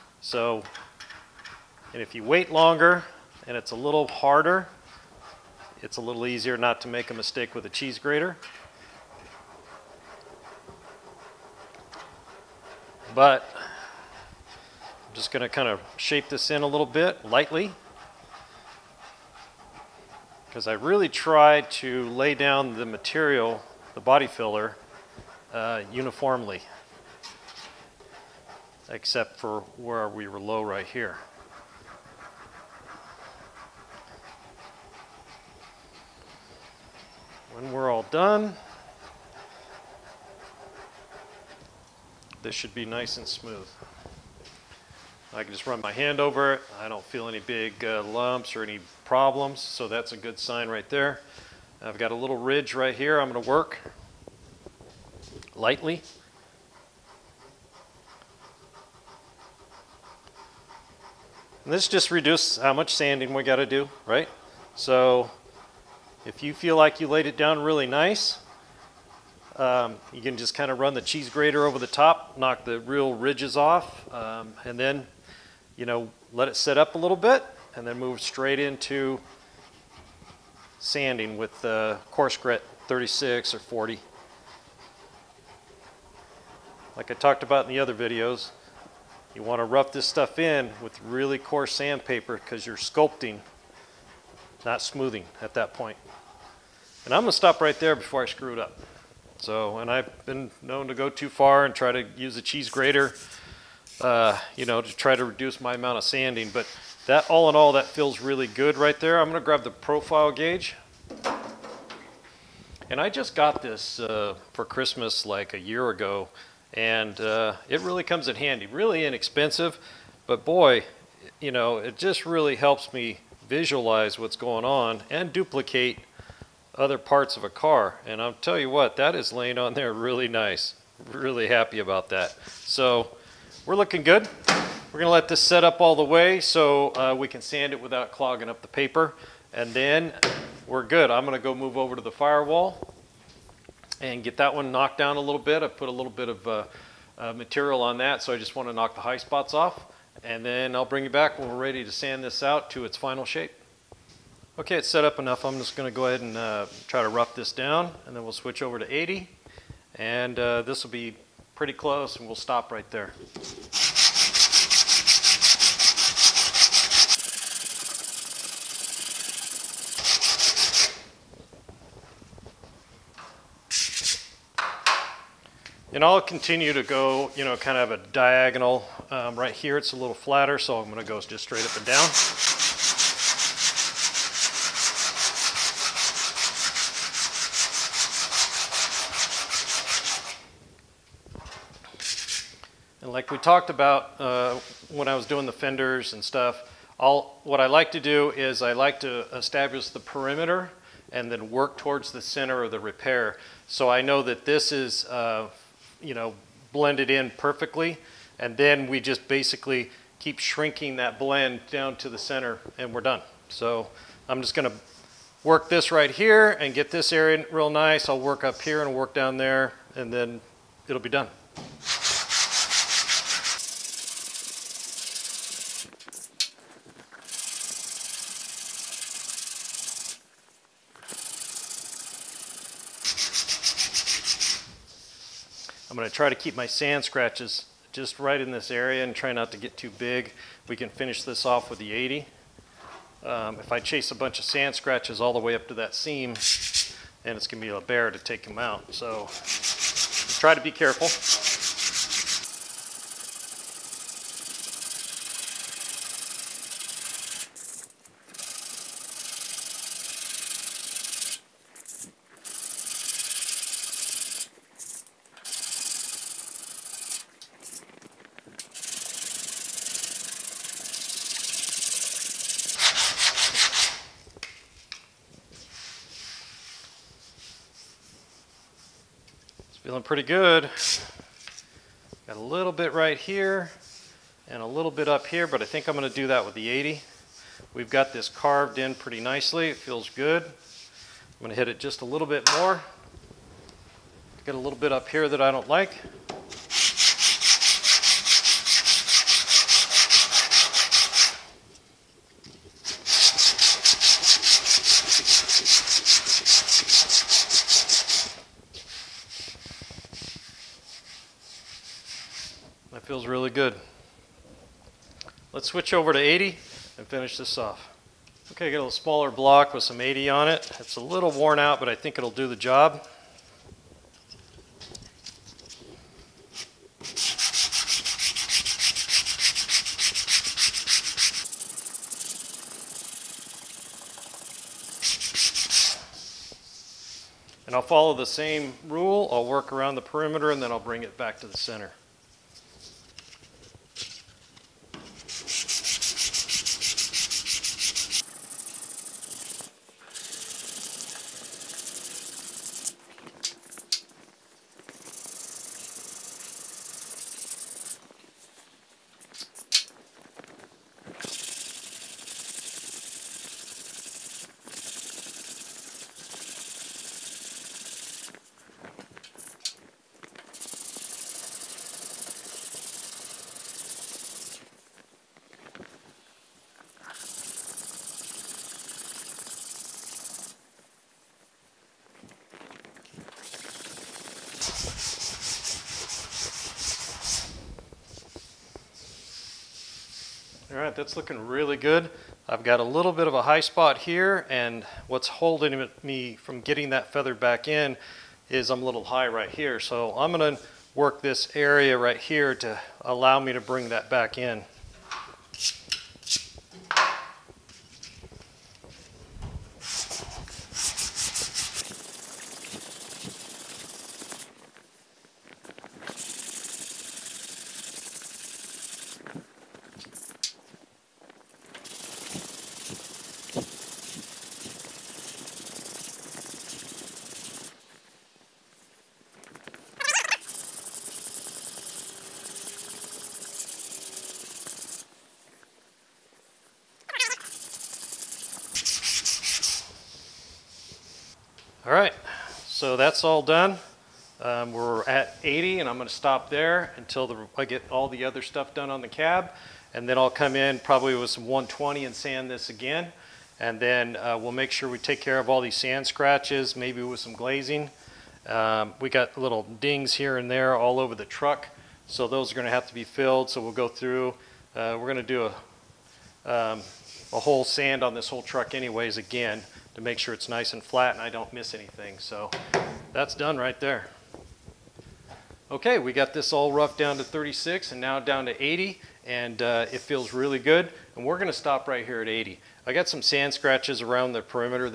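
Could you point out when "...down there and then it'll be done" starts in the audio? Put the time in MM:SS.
03:39.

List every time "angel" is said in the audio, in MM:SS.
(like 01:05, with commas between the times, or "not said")
not said.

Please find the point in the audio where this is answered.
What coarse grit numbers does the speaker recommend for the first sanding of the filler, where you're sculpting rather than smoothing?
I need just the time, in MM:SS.
01:22.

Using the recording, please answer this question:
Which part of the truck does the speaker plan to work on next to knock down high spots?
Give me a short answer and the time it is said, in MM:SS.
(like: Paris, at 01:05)
the firewall, at 02:21.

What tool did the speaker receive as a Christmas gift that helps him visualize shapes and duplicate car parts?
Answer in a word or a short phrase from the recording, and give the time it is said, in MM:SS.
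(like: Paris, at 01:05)
profile gauge, at 01:49.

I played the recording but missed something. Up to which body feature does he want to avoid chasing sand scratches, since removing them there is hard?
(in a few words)
that seam.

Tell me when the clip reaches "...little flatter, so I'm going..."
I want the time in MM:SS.
02:59.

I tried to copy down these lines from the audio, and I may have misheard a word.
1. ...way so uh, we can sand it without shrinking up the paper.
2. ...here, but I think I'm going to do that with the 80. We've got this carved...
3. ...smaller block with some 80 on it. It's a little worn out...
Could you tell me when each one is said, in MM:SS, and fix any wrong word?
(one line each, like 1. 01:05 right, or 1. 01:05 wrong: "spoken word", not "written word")
1. 02:16 wrong: "clogging", not "shrinking"
2. 04:45 right
3. 05:18 right.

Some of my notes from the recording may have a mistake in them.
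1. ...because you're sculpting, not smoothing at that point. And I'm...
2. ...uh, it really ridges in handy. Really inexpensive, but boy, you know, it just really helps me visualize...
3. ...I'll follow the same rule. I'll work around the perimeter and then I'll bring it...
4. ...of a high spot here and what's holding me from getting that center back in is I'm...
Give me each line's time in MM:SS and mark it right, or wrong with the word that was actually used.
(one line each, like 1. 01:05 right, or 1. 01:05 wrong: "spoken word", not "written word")
1. 01:32 right
2. 01:57 wrong: "comes", not "ridges"
3. 05:37 right
4. 06:33 wrong: "feather", not "center".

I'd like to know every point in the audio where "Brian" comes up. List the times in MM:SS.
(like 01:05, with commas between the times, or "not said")
not said.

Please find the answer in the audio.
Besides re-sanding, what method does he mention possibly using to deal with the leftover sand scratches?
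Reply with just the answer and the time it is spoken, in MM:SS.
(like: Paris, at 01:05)
glazing, at 07:37.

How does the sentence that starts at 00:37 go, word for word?
When we're all done, this should be nice and smooth.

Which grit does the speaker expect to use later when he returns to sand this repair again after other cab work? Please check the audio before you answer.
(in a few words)
120.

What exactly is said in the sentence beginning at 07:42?
So those are gonna have to be filled.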